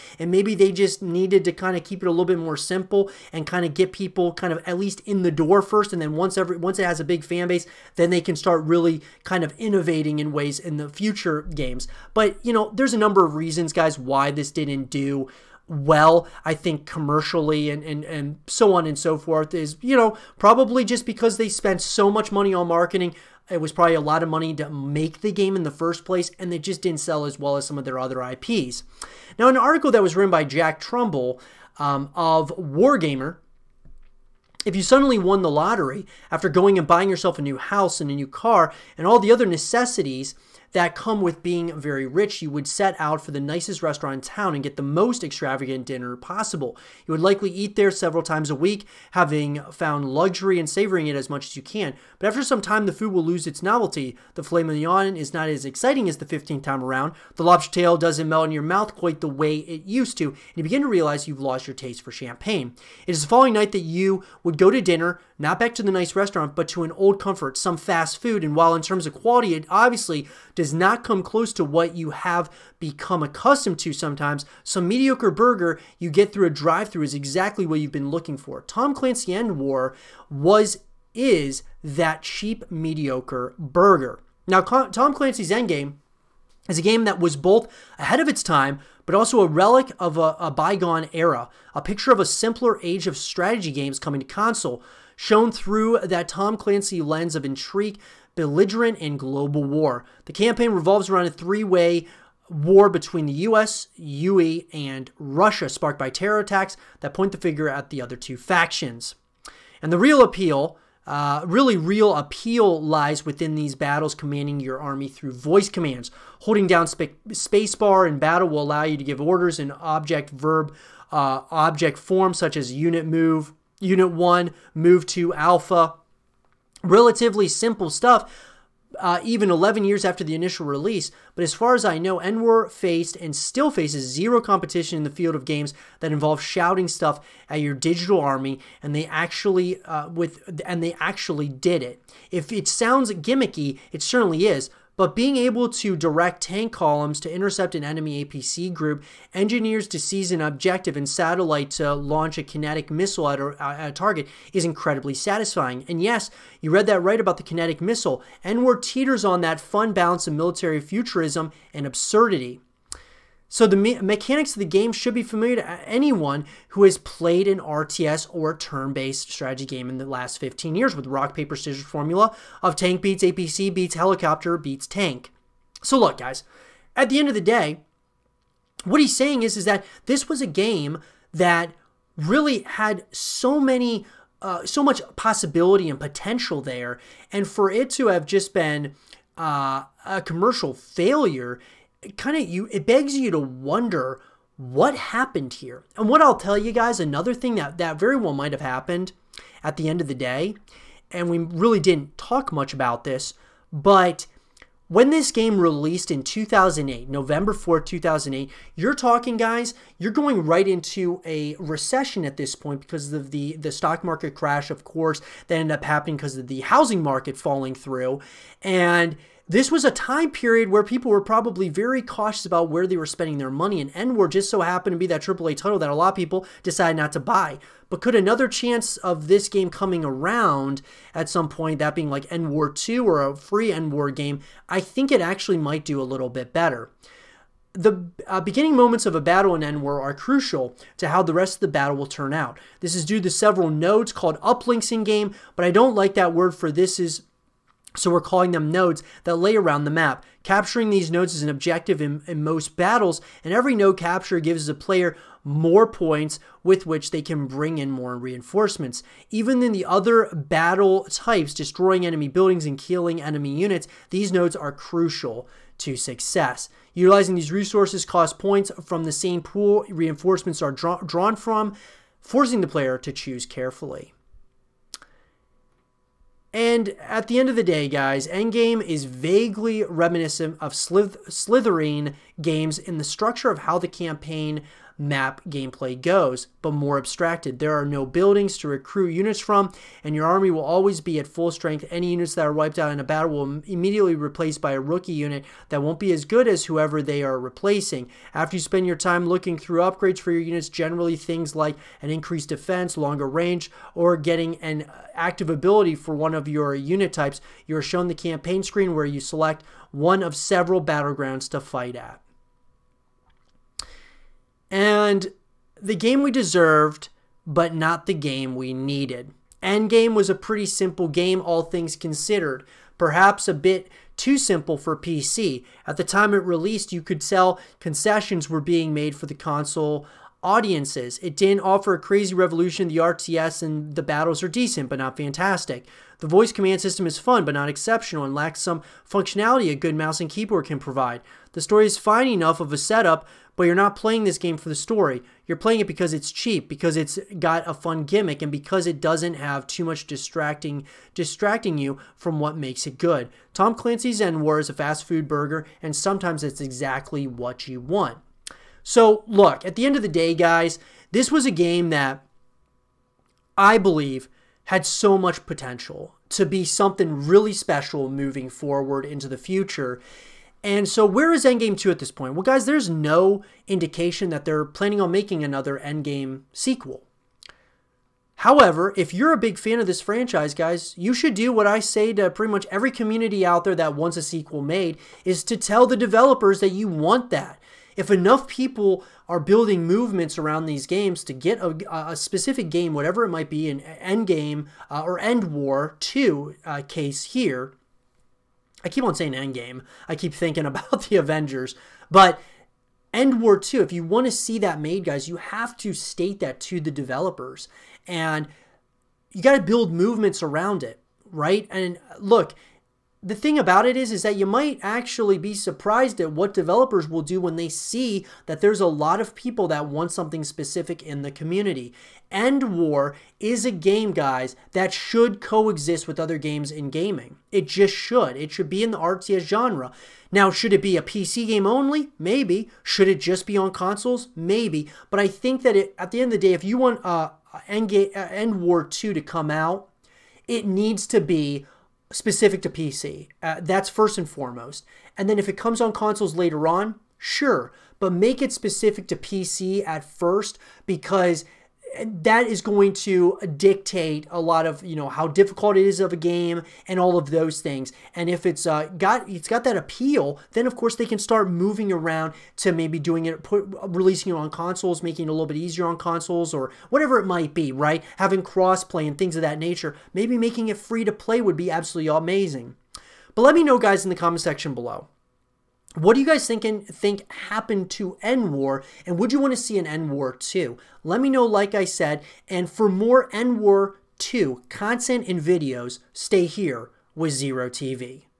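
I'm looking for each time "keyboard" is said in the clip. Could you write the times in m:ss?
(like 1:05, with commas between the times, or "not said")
5:40.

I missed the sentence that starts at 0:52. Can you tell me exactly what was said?
But after some time, the food will lose its novelty.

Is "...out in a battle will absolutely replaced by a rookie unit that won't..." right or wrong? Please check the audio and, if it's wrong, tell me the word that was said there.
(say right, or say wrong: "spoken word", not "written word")
wrong: "immediately", not "absolutely".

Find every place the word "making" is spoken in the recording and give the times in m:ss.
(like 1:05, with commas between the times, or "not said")
6:15, 7:45, 7:50.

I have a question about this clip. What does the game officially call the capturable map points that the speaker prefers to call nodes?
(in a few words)
uplinks.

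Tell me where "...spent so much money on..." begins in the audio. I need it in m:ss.
0:21.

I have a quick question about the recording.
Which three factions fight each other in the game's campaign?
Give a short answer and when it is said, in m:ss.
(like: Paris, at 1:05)
US, UE, and Russia, at 1:43.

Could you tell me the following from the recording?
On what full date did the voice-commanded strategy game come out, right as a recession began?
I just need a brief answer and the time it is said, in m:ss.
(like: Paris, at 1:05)
November 4, 2008, at 3:27.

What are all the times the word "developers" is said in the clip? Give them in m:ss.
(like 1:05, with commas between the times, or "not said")
6:25, 6:46, 6:56.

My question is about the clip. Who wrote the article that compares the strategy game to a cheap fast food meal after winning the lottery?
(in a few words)
Jack Trumbull.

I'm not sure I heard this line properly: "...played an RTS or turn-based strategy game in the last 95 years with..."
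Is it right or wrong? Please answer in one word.
wrong.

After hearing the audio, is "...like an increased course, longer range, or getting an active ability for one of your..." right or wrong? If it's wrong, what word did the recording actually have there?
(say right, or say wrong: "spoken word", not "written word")
wrong: "defense", not "course".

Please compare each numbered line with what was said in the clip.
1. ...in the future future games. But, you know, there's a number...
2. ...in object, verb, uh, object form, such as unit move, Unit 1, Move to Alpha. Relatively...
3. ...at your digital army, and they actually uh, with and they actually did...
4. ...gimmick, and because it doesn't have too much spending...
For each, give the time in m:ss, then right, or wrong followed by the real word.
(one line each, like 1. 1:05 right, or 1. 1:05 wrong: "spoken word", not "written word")
1. 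0:10 right
2. 1:59 right
3. 2:17 right
4. 5:48 wrong: "distracting", not "spending".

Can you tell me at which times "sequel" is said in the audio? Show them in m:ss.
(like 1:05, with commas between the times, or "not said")
6:16, 6:24.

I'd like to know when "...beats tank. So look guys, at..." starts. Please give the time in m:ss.
2:54.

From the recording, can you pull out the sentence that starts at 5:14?
And the game we deserved, but not the game we needed.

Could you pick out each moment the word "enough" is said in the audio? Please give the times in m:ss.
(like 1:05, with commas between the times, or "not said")
5:42, 6:28.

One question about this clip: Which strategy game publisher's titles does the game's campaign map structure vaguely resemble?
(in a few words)
Slitherine.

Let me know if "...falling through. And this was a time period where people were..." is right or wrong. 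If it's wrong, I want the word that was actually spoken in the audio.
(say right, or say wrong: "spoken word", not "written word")
right.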